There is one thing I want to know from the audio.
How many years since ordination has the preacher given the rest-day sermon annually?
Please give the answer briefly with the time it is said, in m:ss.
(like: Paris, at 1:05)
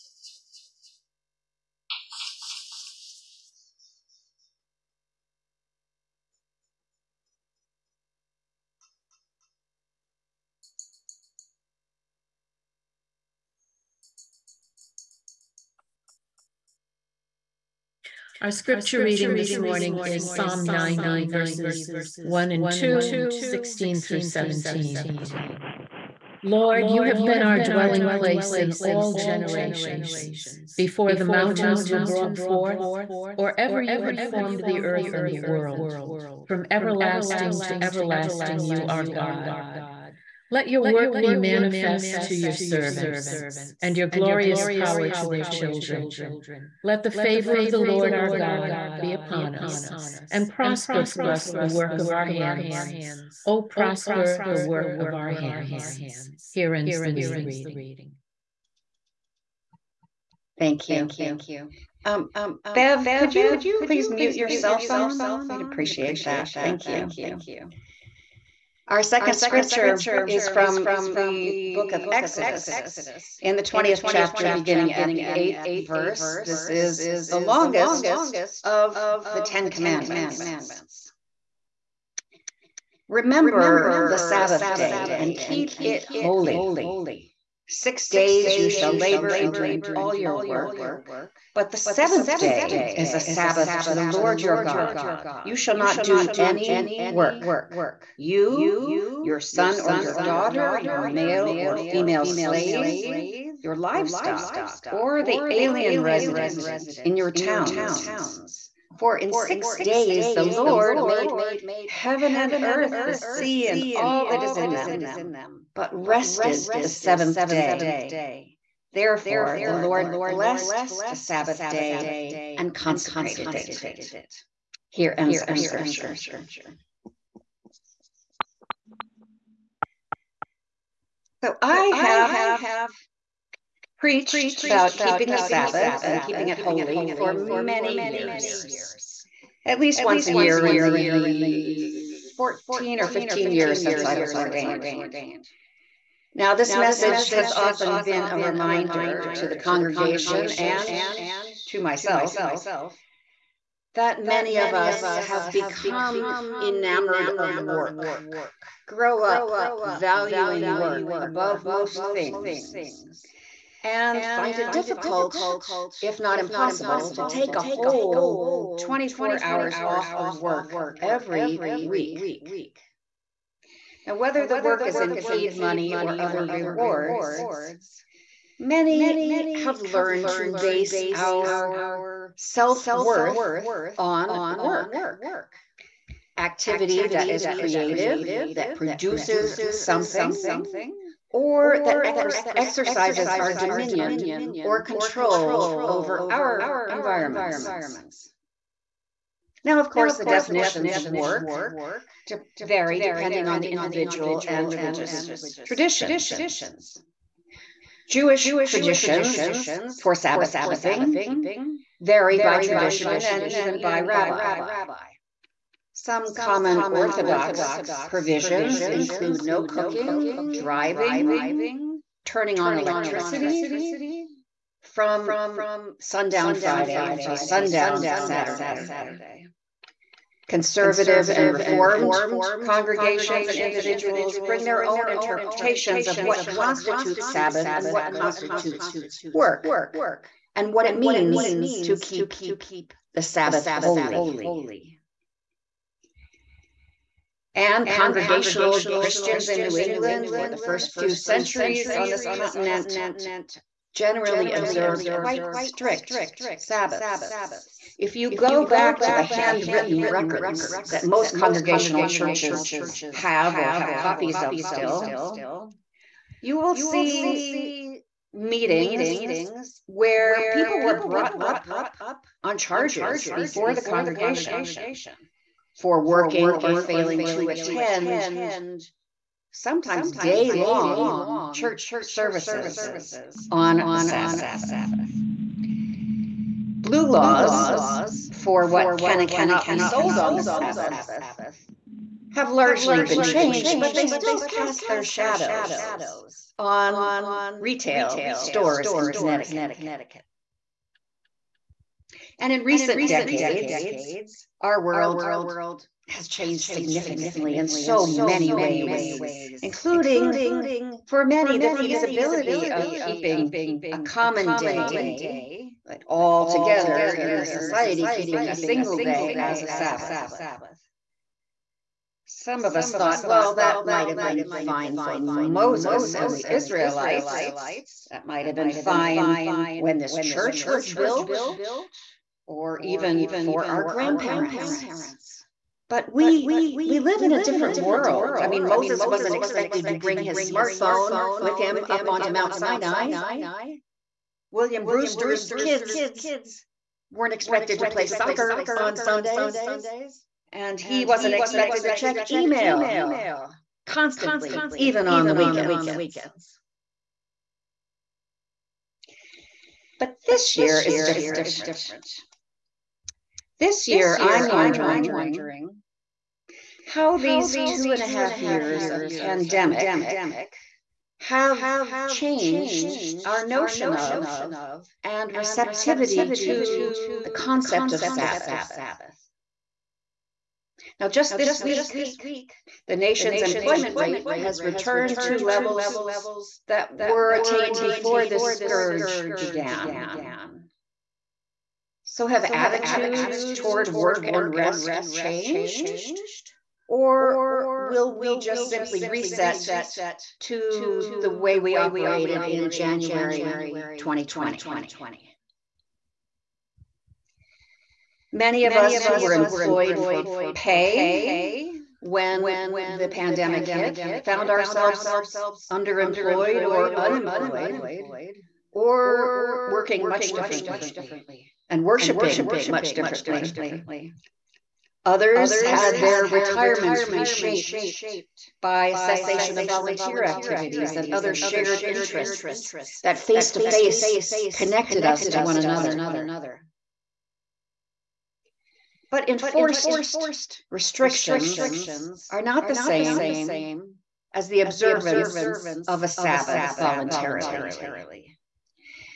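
14 or 15, at 2:22.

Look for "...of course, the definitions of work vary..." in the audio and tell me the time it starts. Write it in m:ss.
3:19.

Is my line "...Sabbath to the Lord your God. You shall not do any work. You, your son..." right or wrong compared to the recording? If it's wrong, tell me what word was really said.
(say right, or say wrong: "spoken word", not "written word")
right.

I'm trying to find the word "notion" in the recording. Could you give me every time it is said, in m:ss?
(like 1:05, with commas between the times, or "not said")
6:13.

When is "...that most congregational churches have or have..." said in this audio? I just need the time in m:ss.
4:20.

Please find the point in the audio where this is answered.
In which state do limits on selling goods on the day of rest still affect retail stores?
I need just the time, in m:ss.
4:59.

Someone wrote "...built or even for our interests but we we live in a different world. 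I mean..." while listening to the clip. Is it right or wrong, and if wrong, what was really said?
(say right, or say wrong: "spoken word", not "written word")
wrong: "grandparents", not "interests".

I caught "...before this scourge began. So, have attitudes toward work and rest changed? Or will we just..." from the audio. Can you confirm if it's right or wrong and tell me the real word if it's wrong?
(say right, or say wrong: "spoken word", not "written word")
right.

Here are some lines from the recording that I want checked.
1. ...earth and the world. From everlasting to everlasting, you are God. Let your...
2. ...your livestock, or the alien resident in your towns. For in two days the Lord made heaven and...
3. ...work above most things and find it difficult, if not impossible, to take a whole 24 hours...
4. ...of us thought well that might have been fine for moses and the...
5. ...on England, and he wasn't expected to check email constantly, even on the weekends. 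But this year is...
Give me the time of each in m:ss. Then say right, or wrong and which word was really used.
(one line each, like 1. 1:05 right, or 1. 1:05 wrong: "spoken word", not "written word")
1. 0:34 right
2. 1:43 wrong: "six", not "two"
3. 2:40 right
4. 5:22 right
5. 5:48 wrong: "Sundays", not "England".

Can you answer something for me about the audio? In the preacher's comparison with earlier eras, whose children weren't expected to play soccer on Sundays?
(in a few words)
William Brewster.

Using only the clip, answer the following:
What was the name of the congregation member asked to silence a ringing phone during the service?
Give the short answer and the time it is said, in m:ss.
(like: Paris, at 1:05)
Bev, at 1:02.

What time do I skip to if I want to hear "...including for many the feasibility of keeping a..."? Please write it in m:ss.
5:09.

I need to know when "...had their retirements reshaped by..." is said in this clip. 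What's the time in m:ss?
7:05.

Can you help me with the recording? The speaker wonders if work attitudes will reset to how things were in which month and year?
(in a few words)
January 2020.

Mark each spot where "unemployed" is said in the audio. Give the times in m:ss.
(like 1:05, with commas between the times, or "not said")
6:56.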